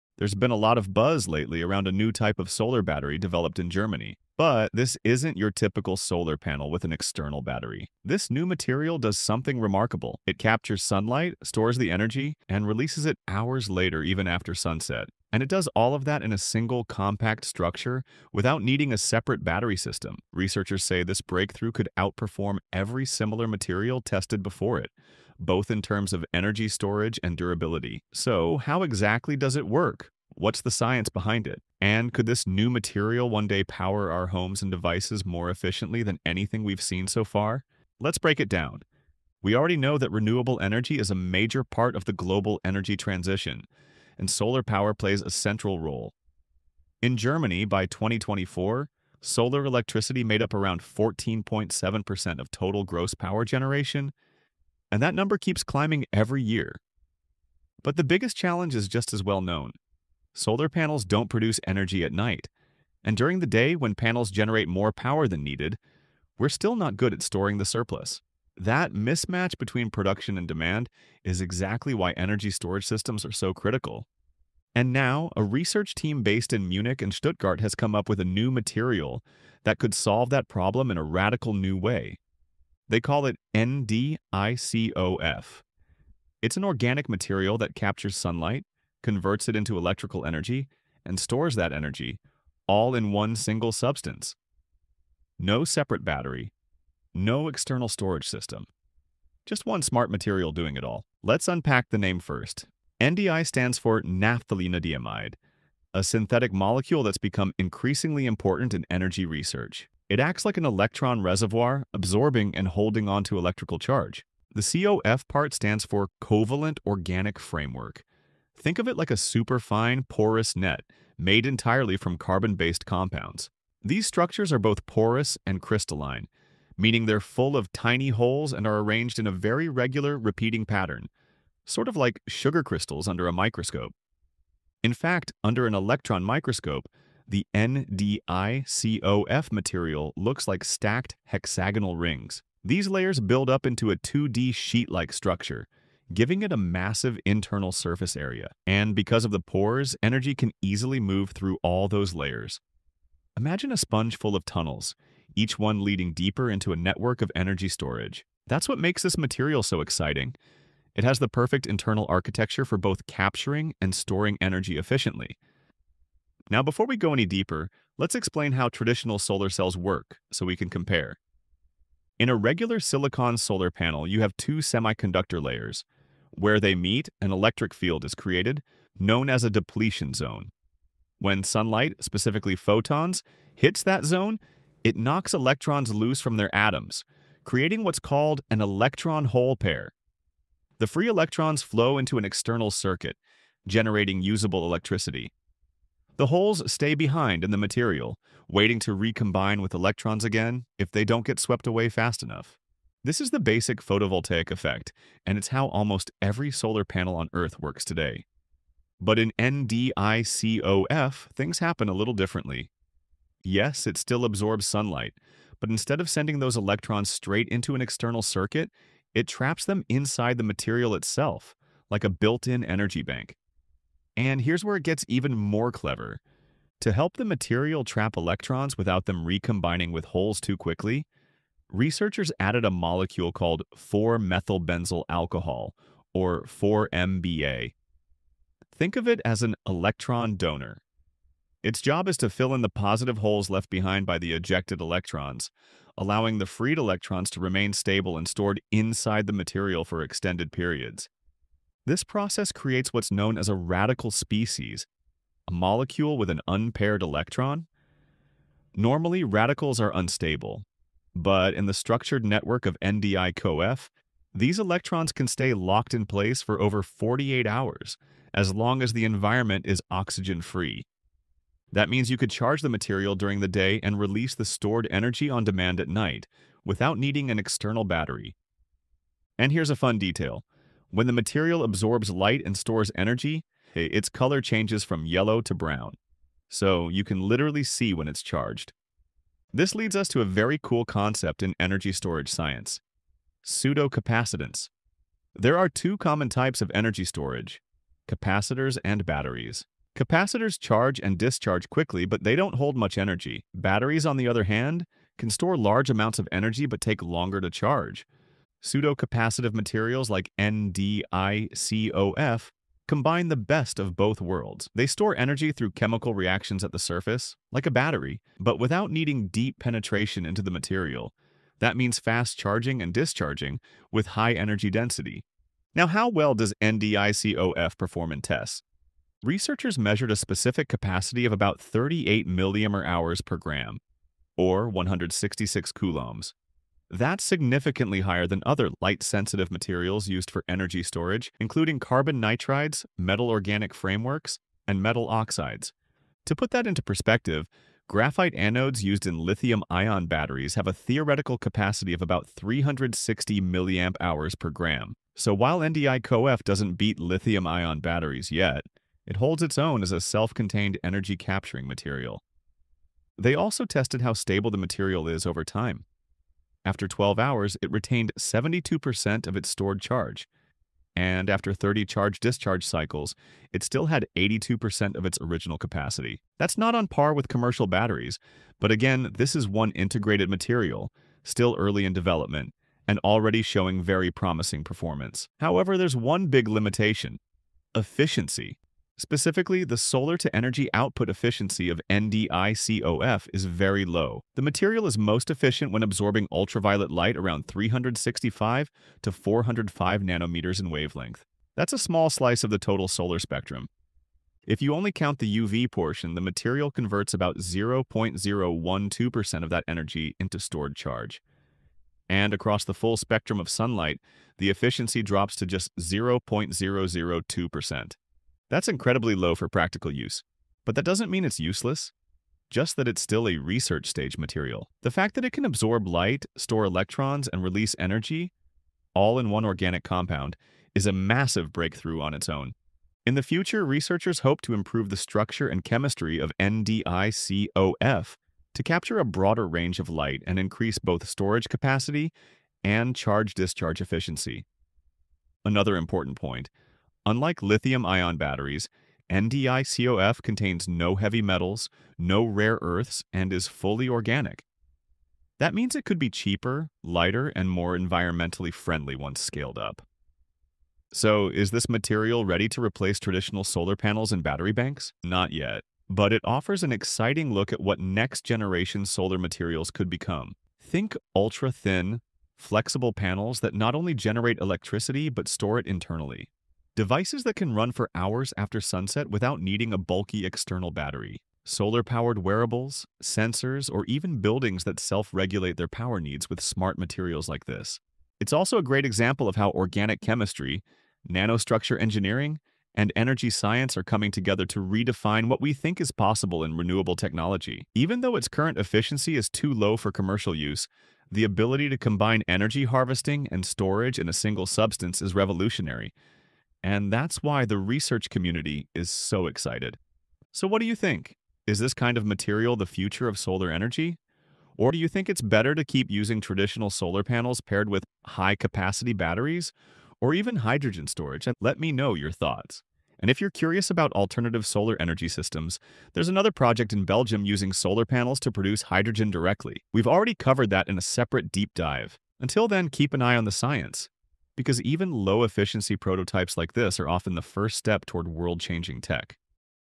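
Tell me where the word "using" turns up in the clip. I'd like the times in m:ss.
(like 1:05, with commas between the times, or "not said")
8:35, 8:47.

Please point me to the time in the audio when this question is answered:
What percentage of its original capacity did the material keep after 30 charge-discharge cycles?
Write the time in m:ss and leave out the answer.
6:14.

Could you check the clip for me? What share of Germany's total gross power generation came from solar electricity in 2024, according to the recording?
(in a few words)
14.7%.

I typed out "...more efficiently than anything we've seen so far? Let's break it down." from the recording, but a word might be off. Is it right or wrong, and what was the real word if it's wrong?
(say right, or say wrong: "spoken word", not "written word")
right.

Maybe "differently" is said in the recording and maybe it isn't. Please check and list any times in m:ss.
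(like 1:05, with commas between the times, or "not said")
3:32.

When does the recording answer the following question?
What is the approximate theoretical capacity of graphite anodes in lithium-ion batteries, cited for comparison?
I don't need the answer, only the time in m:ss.
5:52.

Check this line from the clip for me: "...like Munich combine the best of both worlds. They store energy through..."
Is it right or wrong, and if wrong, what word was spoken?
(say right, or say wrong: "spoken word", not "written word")
wrong: "NDICOF", not "Munich".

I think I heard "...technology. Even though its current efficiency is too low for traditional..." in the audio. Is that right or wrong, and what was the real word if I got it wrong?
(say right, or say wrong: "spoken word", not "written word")
wrong: "commercial", not "traditional".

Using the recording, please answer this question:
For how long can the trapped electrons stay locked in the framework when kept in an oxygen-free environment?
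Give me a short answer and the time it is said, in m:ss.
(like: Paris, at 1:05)
over 48 hours, at 4:26.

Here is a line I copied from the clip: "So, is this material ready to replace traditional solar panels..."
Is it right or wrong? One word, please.
right.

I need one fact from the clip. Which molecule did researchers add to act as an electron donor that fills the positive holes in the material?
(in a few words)
4-methylbenzyl alcohol.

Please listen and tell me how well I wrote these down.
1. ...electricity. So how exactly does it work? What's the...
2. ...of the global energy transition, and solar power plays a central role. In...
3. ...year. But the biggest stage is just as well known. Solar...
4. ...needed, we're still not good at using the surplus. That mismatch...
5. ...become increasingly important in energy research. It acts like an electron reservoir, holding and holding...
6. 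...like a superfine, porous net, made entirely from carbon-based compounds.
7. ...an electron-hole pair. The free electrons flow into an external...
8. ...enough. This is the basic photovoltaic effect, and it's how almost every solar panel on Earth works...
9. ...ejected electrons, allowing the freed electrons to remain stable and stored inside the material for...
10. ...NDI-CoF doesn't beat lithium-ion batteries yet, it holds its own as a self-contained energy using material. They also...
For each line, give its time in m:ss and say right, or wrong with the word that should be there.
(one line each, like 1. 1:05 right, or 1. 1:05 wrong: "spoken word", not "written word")
1. 0:27 wrong: "durability", not "electricity"
2. 0:41 right
3. 0:56 wrong: "challenge", not "stage"
4. 1:05 wrong: "storing", not "using"
5. 1:47 wrong: "absorbing", not "holding"
6. 1:58 right
7. 3:08 right
8. 3:22 right
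9. 4:04 right
10. 5:55 wrong: "capturing", not "using".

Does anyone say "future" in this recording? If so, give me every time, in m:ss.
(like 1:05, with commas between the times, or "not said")
7:13, 8:32.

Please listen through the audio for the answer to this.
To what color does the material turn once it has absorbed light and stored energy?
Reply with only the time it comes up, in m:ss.
4:45.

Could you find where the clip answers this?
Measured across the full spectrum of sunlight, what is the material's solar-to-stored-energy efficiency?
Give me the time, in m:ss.
6:55.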